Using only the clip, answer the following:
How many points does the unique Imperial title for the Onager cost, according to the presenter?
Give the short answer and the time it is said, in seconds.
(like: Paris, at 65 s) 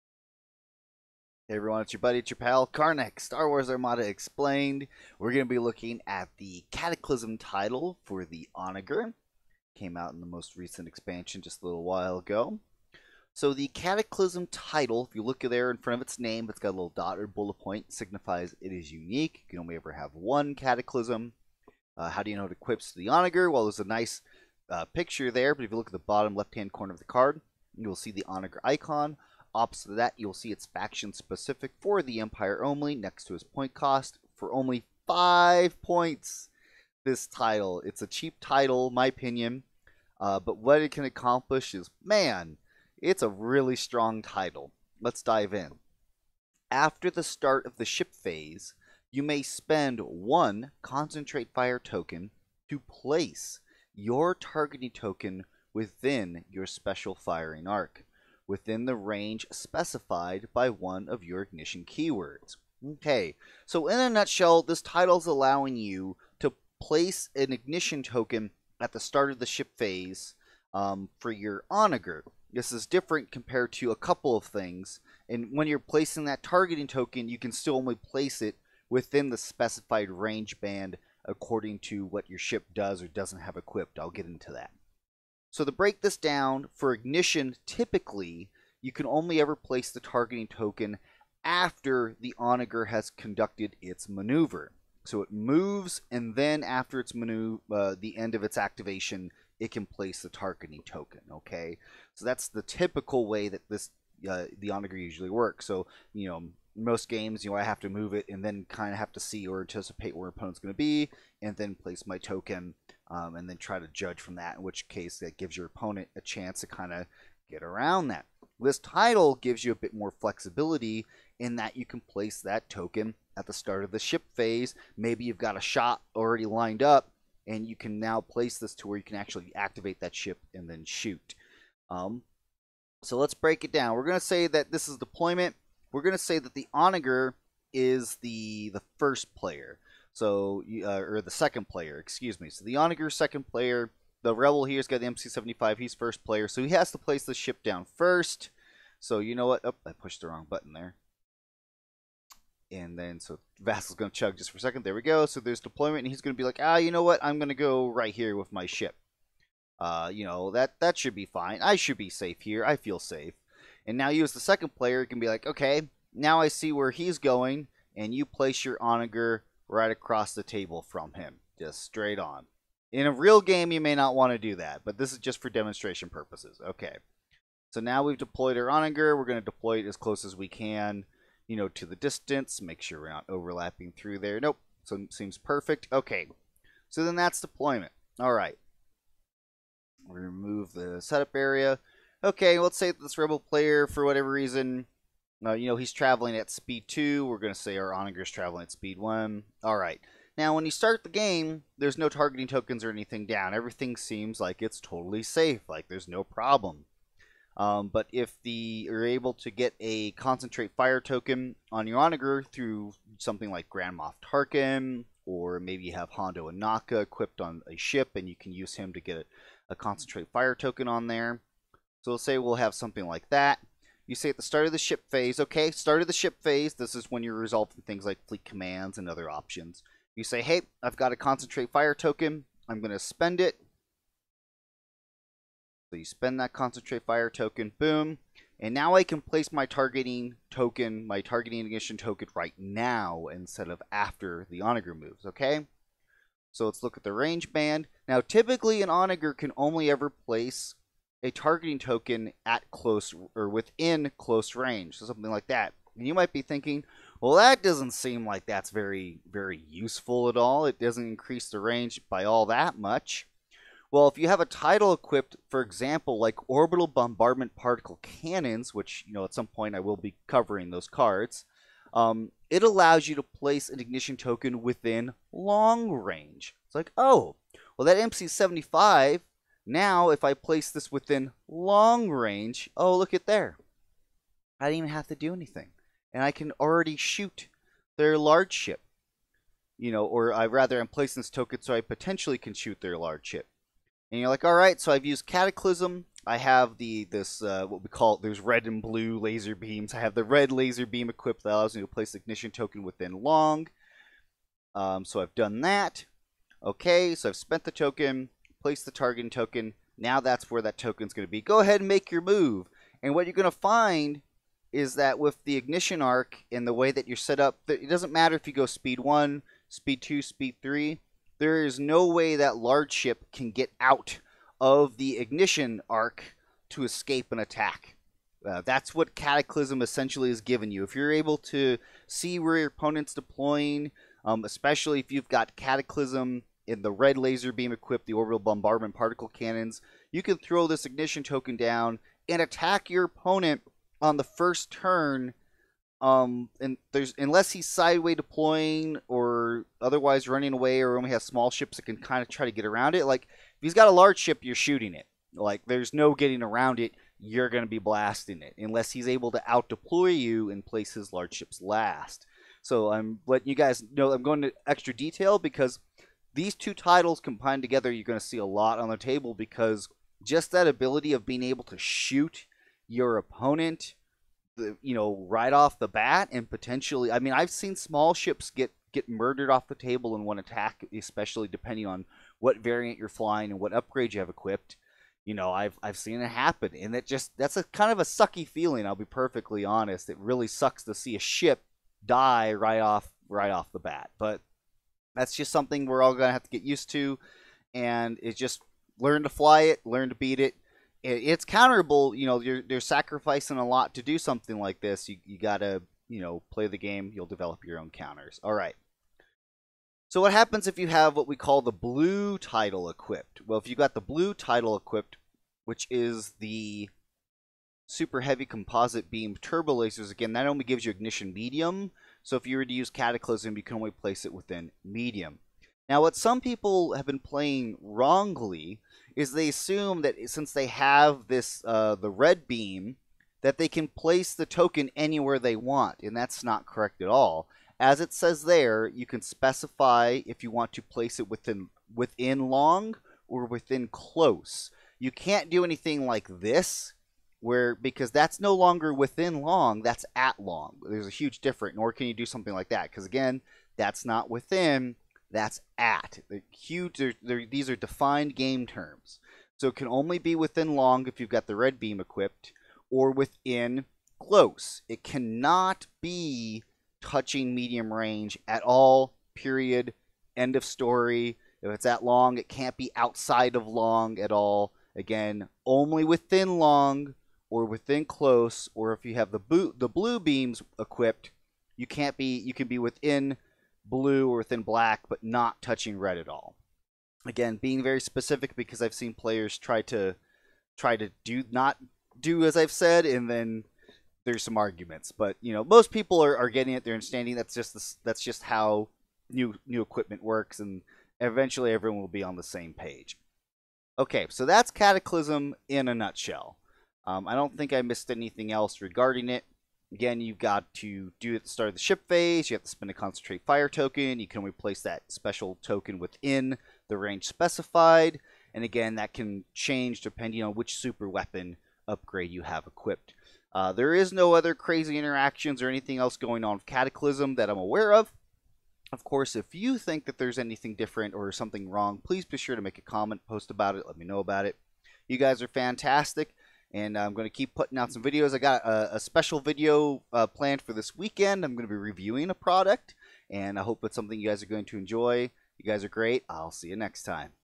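5, at 35 s.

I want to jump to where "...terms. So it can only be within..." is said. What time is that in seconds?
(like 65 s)
458 s.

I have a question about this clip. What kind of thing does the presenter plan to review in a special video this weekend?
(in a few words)
a product.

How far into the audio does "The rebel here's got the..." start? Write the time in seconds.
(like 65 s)
144 s.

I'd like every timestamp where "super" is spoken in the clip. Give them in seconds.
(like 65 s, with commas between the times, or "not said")
417 s, 520 s.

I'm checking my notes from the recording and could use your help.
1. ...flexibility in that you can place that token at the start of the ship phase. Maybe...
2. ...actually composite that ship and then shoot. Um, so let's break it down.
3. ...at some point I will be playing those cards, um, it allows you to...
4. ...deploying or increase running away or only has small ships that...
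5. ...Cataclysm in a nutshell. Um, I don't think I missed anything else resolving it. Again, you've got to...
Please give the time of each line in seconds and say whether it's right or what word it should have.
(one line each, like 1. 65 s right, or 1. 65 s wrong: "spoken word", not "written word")
1. 120 s right
2. 129 s wrong: "activate", not "composite"
3. 269 s wrong: "covering", not "playing"
4. 348 s wrong: "otherwise", not "increase"
5. 504 s wrong: "regarding", not "resolving".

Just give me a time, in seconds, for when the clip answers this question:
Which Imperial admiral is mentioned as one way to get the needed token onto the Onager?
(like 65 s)
213 s.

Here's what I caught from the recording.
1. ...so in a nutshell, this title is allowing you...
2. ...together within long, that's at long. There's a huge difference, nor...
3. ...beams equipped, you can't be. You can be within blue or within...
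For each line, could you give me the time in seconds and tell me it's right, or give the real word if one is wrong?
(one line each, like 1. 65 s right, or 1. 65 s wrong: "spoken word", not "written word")
1. 63 s right
2. 448 s wrong: "longer", not "together"
3. 480 s right.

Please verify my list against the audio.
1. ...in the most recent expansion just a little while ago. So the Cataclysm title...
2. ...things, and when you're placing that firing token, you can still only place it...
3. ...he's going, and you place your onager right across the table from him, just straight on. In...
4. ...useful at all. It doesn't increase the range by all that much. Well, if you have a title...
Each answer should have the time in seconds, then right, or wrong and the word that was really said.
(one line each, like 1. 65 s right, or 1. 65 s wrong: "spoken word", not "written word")
1. 10 s right
2. 74 s wrong: "targeting", not "firing"
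3. 166 s right
4. 259 s right.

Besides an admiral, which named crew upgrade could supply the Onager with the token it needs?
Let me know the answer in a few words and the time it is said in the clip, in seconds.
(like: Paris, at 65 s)
Hondo Ohnaka, at 216 s.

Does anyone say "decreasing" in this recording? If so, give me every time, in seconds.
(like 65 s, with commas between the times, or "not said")
not said.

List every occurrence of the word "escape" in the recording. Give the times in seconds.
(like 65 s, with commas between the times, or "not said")
326 s.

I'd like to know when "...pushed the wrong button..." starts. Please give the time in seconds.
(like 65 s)
149 s.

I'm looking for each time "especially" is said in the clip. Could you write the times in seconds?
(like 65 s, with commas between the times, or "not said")
334 s, 380 s.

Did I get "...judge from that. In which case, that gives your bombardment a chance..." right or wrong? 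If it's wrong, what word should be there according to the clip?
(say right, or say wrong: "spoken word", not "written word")
wrong: "opponent", not "bombardment".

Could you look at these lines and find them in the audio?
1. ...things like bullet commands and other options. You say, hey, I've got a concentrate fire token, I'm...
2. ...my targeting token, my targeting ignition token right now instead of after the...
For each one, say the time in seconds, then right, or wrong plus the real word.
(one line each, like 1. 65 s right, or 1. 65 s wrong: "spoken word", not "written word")
1. 227 s wrong: "fleet", not "bullet"
2. 239 s right.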